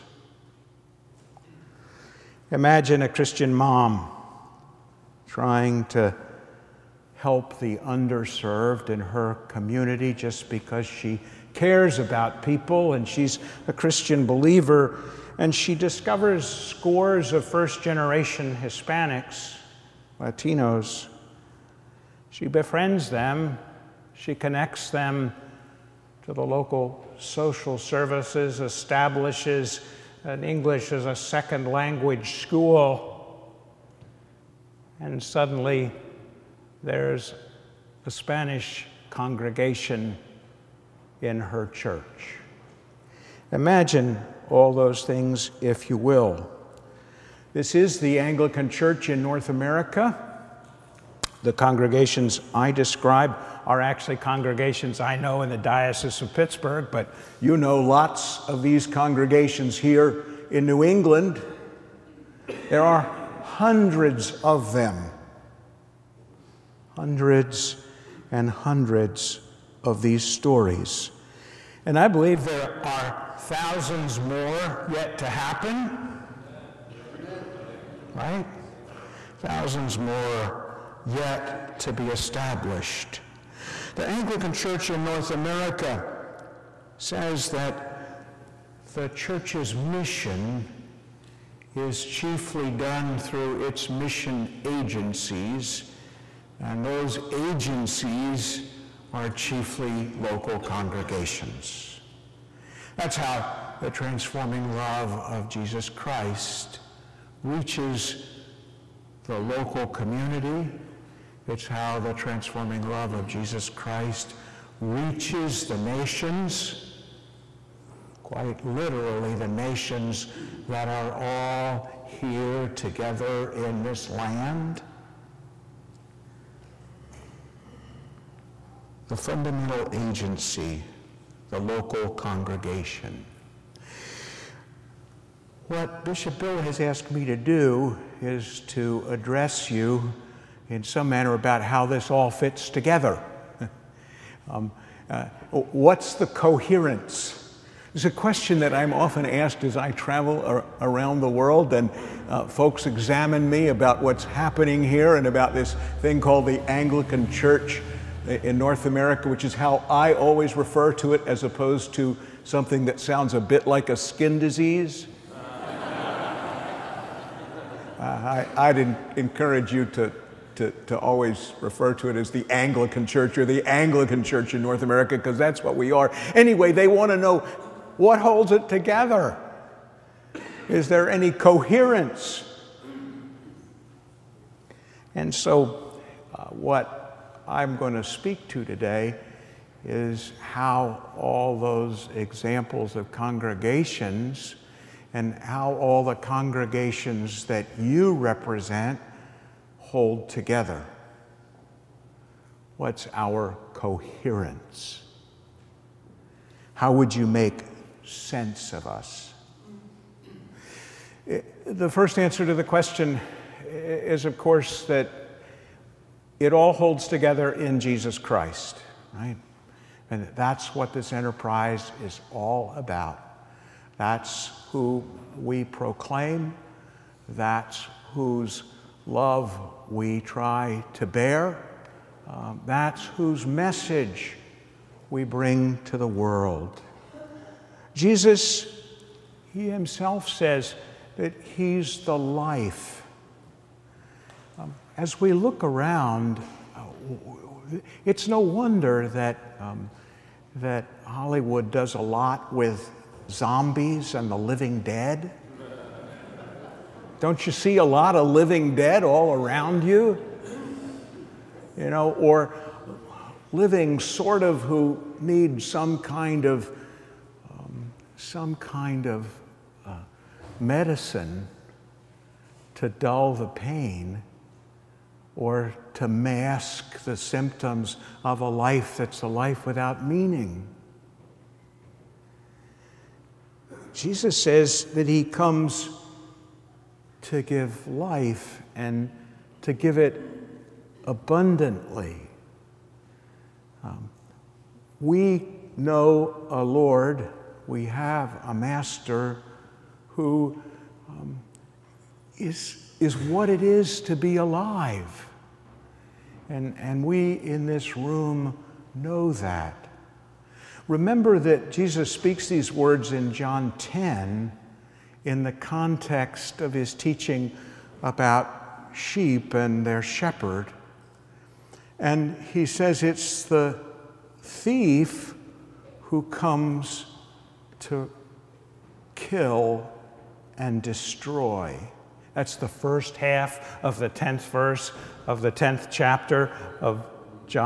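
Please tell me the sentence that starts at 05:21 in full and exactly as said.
And he says it's the thief who comes to kill and destroy.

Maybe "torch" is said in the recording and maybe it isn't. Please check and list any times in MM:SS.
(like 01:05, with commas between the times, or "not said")
not said.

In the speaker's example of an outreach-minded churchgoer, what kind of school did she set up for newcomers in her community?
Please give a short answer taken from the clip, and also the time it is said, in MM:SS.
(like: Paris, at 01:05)
English as a second language school, at 00:30.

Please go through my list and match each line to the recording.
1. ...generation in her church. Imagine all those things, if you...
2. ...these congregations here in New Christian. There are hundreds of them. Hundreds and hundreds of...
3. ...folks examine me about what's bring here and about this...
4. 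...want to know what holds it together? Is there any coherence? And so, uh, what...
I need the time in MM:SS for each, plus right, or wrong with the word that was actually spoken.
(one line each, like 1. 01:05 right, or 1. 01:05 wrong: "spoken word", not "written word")
1. 00:39 wrong: "congregation", not "generation"
2. 00:58 wrong: "England", not "Christian"
3. 02:32 wrong: "happening", not "bring"
4. 02:56 right.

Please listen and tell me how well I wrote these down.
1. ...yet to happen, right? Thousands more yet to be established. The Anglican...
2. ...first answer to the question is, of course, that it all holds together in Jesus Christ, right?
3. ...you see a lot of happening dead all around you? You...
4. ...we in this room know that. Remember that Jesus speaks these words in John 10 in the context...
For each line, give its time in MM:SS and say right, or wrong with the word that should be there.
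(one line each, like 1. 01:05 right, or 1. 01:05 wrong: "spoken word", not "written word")
1. 01:14 right
2. 03:31 right
3. 04:17 wrong: "living", not "happening"
4. 05:07 right.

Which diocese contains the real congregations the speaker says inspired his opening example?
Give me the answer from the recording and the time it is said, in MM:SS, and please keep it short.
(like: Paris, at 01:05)
Diocese of Pittsburgh, at 00:55.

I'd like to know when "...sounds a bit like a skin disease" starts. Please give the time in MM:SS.
02:43.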